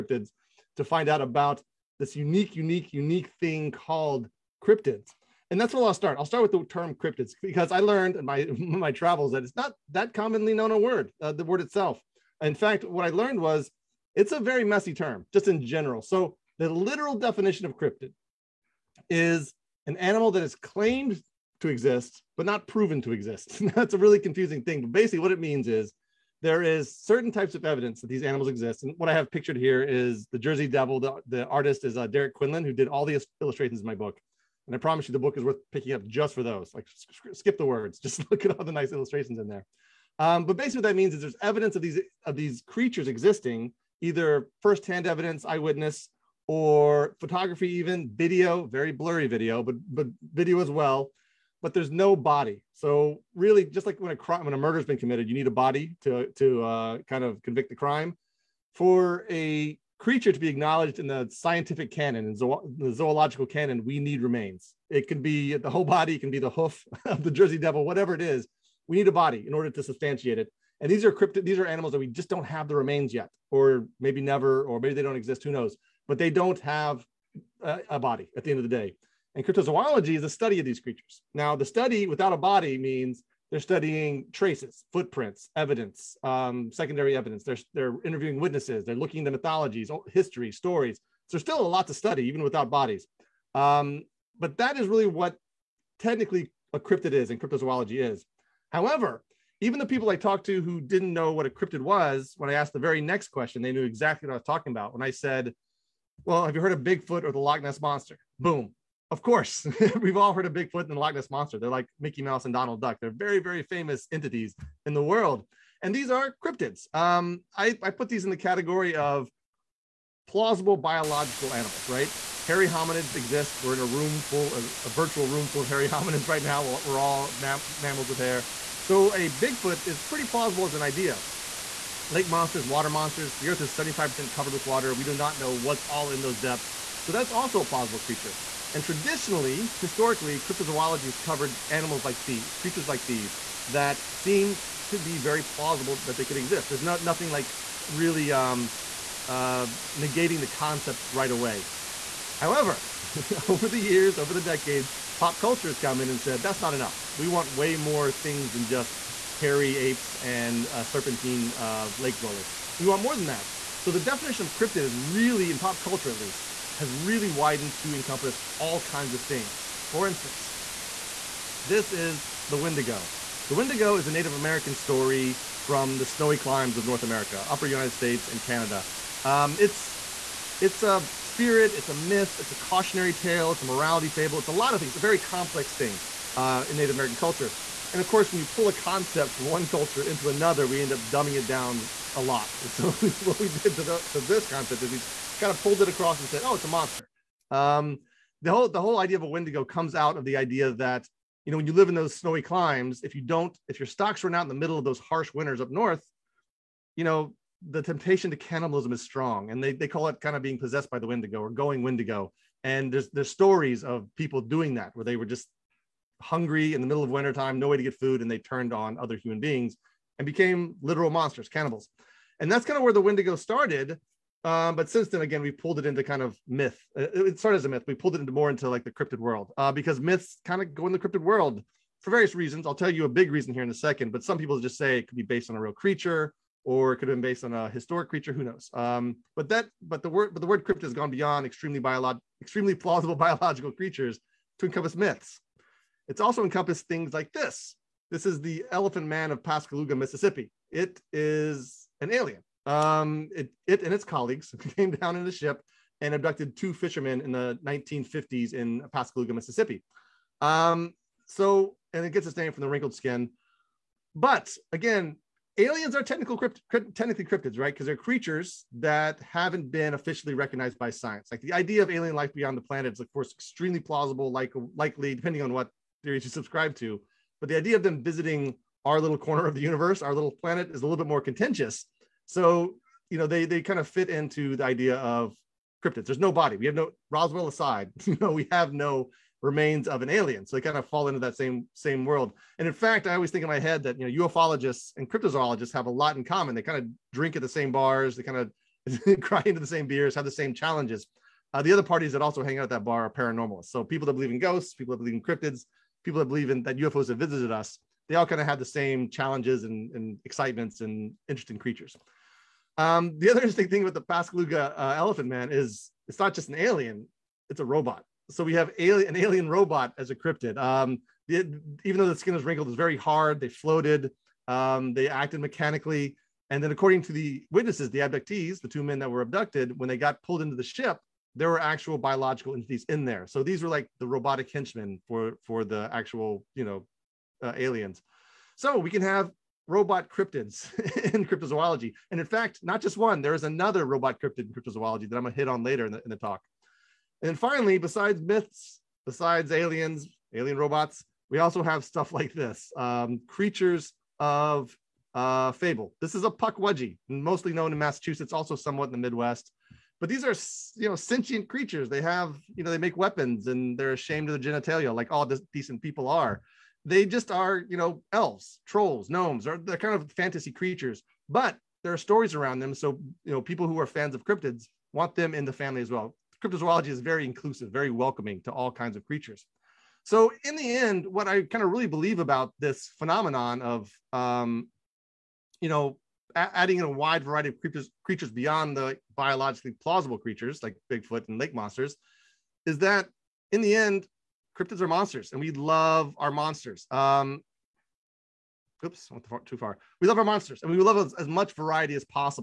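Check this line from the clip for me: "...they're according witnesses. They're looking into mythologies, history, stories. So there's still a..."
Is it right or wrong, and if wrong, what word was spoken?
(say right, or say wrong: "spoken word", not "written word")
wrong: "interviewing", not "according".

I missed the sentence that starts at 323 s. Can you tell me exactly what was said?
They floated, um, they acted mechanically.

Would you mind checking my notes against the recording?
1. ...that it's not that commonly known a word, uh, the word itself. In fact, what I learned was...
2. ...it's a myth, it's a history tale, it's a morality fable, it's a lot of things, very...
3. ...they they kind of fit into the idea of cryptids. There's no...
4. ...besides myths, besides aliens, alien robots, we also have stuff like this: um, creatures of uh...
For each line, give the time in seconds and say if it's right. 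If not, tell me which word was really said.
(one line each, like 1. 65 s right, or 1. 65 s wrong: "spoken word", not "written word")
1. 9 s right
2. 181 s wrong: "cautionary", not "history"
3. 283 s right
4. 347 s right.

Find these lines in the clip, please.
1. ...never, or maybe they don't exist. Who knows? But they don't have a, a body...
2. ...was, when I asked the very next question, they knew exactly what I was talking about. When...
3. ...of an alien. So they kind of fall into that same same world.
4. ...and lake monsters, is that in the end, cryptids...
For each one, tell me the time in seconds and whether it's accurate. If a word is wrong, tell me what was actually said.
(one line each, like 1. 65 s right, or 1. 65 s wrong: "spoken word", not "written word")
1. 74 s right
2. 101 s right
3. 289 s right
4. 391 s right.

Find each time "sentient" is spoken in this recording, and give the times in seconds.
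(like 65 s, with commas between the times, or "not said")
360 s.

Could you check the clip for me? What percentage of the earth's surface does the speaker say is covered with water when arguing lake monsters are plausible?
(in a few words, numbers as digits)
75%.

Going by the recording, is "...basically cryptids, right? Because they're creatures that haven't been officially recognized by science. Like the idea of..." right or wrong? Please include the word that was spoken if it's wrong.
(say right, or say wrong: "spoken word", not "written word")
wrong: "technically", not "basically".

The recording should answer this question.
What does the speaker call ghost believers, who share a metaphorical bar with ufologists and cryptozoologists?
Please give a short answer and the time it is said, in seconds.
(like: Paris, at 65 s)
paranormalists, at 303 s.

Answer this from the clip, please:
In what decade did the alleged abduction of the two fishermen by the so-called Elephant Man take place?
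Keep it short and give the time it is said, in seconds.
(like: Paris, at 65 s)
1950s, at 257 s.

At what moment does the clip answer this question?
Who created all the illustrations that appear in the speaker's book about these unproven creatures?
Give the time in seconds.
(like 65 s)
32 s.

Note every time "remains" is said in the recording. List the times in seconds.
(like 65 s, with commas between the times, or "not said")
64 s, 72 s, 289 s.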